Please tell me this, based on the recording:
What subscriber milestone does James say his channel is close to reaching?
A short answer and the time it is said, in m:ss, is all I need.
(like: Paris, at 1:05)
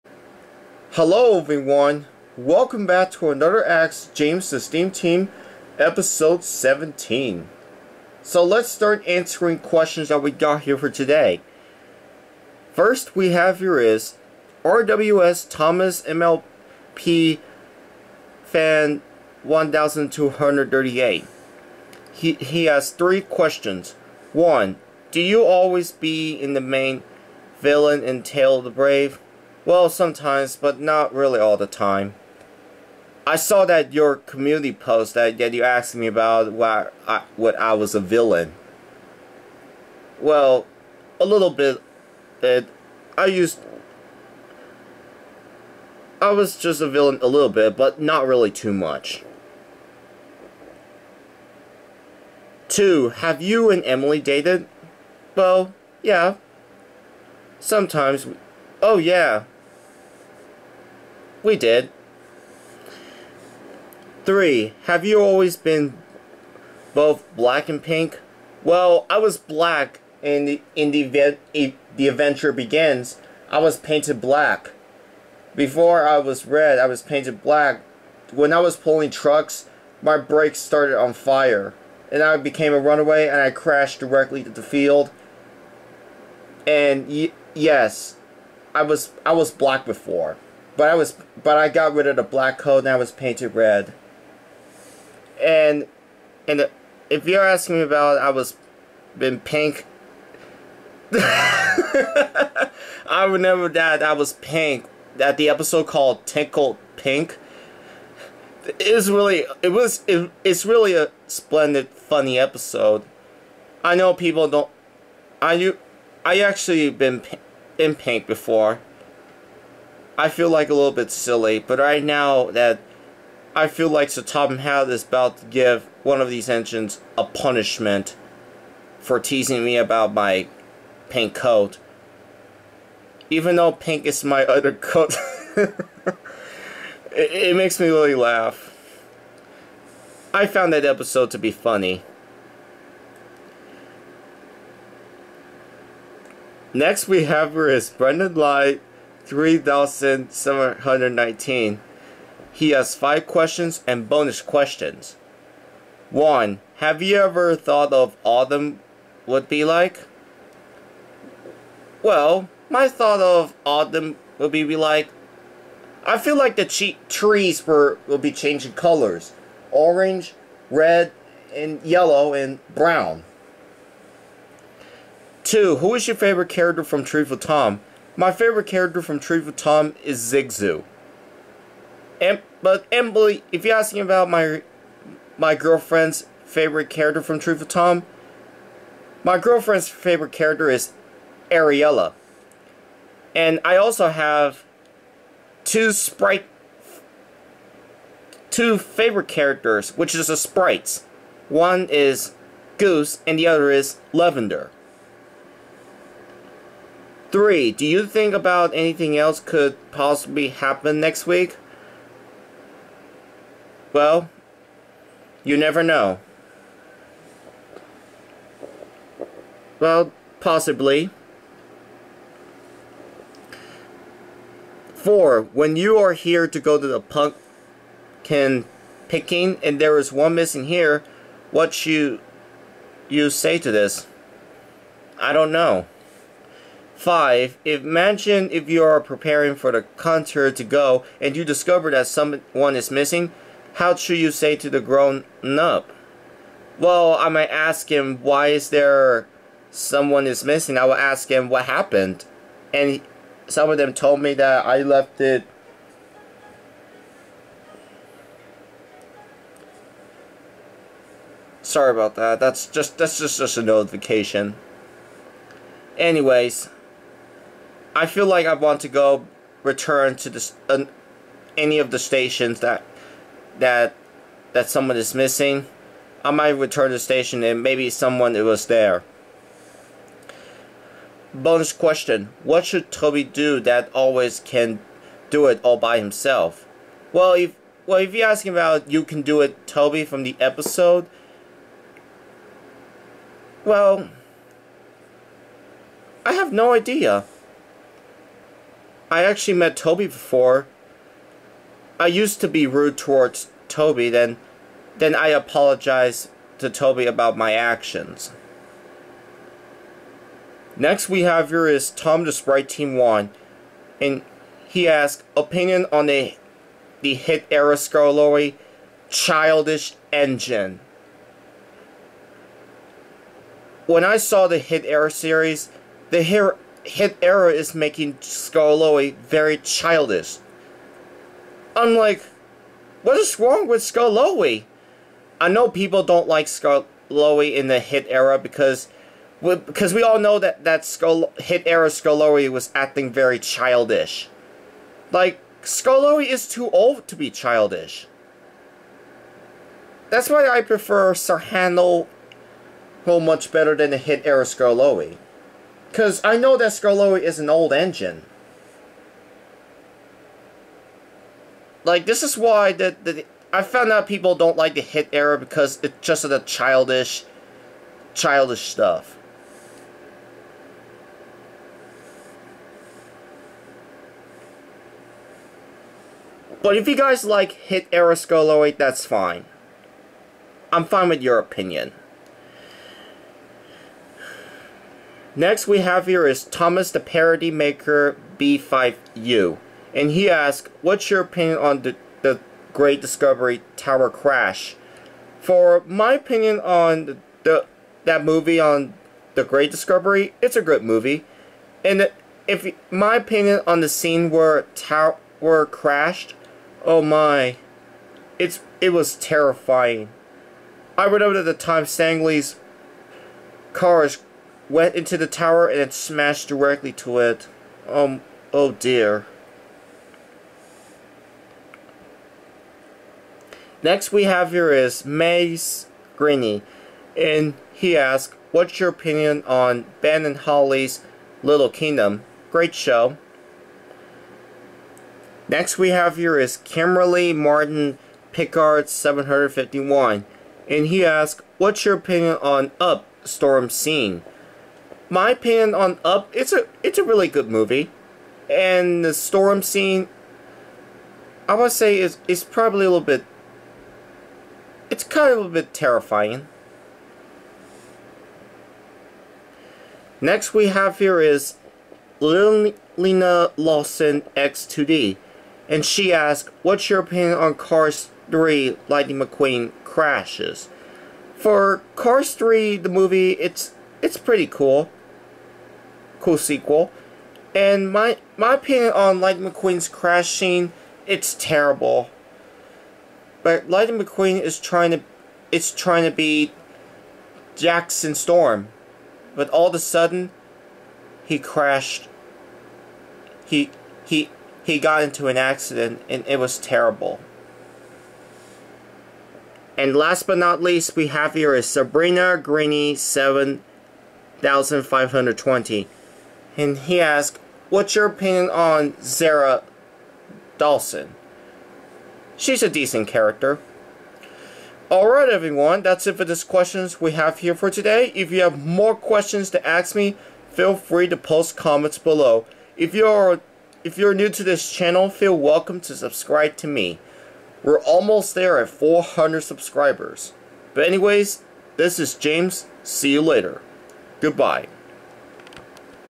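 400, at 8:48.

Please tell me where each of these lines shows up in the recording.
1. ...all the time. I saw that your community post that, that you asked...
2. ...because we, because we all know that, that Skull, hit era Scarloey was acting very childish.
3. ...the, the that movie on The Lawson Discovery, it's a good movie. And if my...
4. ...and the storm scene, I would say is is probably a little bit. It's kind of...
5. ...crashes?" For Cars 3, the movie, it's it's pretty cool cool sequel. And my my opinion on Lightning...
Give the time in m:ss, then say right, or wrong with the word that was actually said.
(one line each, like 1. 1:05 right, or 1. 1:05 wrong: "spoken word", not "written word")
1. 0:31 right
2. 5:38 right
3. 6:37 wrong: "Great", not "Lawson"
4. 7:28 right
5. 7:49 right.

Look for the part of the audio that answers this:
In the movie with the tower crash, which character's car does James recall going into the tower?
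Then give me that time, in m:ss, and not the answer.
6:51.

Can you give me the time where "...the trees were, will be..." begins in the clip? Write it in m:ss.
2:46.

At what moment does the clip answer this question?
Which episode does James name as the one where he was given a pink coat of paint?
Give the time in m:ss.
1:46.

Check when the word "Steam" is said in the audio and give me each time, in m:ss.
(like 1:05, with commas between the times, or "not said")
0:04.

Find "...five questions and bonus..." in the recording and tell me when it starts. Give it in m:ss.
2:32.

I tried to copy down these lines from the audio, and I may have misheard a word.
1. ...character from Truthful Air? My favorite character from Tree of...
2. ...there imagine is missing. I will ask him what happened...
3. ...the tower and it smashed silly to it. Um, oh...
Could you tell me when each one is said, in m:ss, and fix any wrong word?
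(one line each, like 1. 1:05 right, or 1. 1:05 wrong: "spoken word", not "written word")
1. 2:56 wrong: "Tom", not "Air"
2. 4:08 wrong: "someone", not "imagine"
3. 6:55 wrong: "directly", not "silly".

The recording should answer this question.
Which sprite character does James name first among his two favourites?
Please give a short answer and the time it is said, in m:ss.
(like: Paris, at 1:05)
Goose, at 3:22.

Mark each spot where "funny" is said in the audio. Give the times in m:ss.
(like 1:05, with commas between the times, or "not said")
1:51, 2:21.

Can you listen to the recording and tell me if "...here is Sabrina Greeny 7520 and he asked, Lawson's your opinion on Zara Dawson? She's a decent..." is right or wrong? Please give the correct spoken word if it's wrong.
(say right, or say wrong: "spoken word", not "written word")
wrong: "What", not "Lawson".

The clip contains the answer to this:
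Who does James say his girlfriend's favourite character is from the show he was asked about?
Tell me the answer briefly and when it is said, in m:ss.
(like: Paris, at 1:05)
Ariella, at 3:11.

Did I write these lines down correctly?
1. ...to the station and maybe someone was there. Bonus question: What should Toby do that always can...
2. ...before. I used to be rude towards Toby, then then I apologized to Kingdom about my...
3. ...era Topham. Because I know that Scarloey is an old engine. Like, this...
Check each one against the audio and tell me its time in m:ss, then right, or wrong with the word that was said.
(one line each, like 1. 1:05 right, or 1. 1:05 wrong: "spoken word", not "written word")
1. 4:36 right
2. 5:00 wrong: "Toby", not "Kingdom"
3. 5:54 wrong: "Scarloey", not "Topham".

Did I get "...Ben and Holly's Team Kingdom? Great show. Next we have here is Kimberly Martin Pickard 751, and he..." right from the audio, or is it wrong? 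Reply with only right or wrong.
wrong.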